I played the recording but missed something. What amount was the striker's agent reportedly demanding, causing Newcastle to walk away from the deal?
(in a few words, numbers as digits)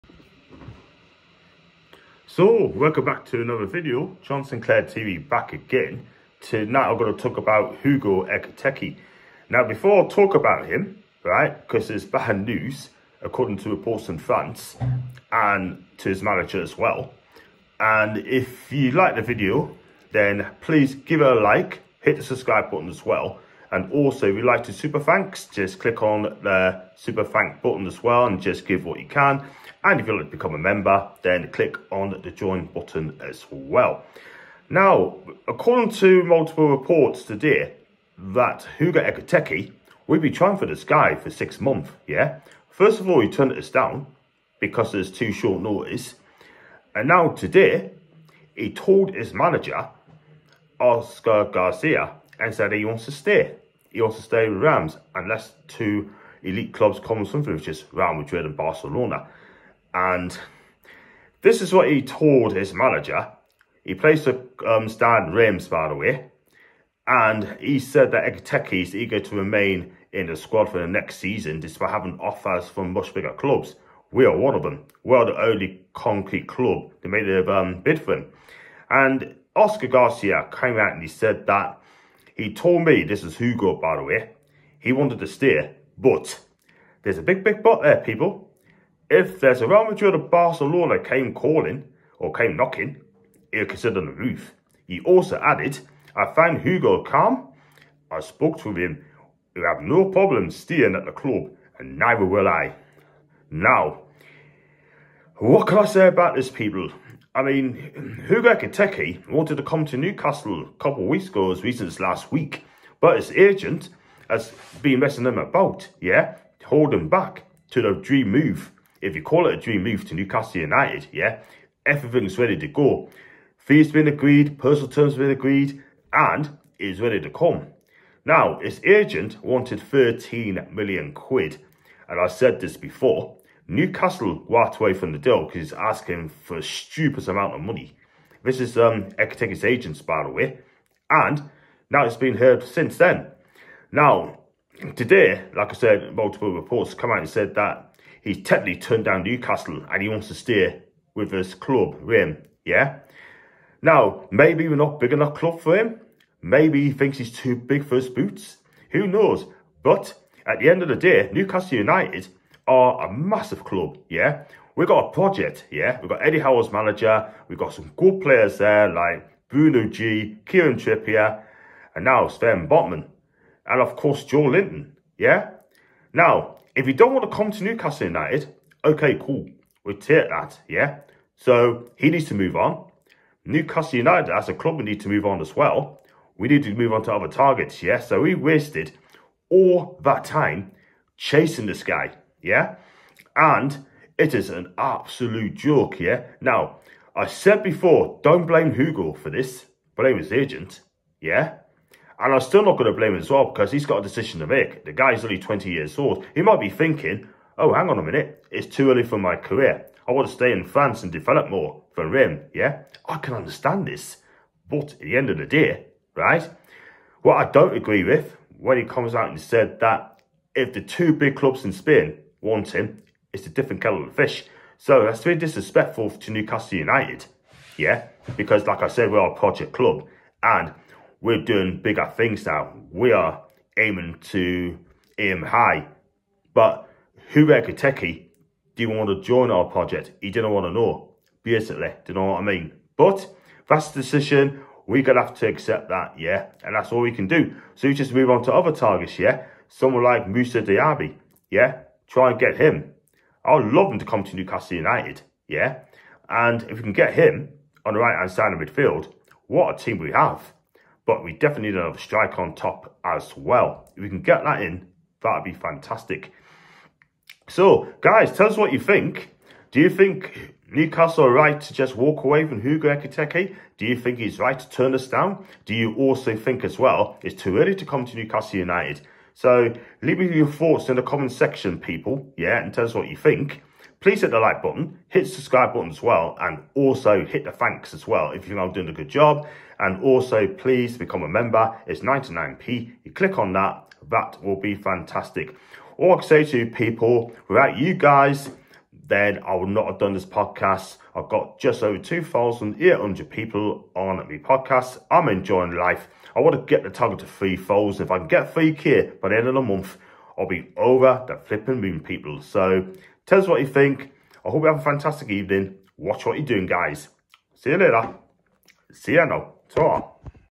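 13 million pounds.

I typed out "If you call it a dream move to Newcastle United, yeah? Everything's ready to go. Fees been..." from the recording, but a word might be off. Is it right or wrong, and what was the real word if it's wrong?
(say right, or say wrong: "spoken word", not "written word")
right.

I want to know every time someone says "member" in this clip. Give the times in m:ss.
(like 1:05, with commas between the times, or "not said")
0:30, 4:51.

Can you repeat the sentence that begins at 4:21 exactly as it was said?
But we definitely need another striker on top as well.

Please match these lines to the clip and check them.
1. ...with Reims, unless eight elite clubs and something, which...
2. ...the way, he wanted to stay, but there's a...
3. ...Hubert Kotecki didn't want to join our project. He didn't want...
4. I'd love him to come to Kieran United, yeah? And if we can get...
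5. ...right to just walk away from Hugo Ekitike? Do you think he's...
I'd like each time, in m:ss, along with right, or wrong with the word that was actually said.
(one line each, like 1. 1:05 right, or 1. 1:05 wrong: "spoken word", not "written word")
1. 0:54 wrong: "two", not "eight"
2. 1:23 right
3. 3:57 right
4. 4:13 wrong: "Newcastle", not "Kieran"
5. 4:31 right.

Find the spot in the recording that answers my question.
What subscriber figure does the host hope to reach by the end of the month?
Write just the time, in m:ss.
5:08.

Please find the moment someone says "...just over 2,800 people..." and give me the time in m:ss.
5:01.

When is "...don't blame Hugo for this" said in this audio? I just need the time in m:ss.
3:18.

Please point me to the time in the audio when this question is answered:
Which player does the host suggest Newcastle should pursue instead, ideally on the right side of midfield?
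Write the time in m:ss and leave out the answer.
4:10.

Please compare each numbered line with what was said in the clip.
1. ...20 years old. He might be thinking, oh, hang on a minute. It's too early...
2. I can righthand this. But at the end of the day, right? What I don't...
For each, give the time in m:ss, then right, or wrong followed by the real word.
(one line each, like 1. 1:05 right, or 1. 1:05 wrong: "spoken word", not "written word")
1. 3:25 right
2. 3:33 wrong: "understand", not "righthand".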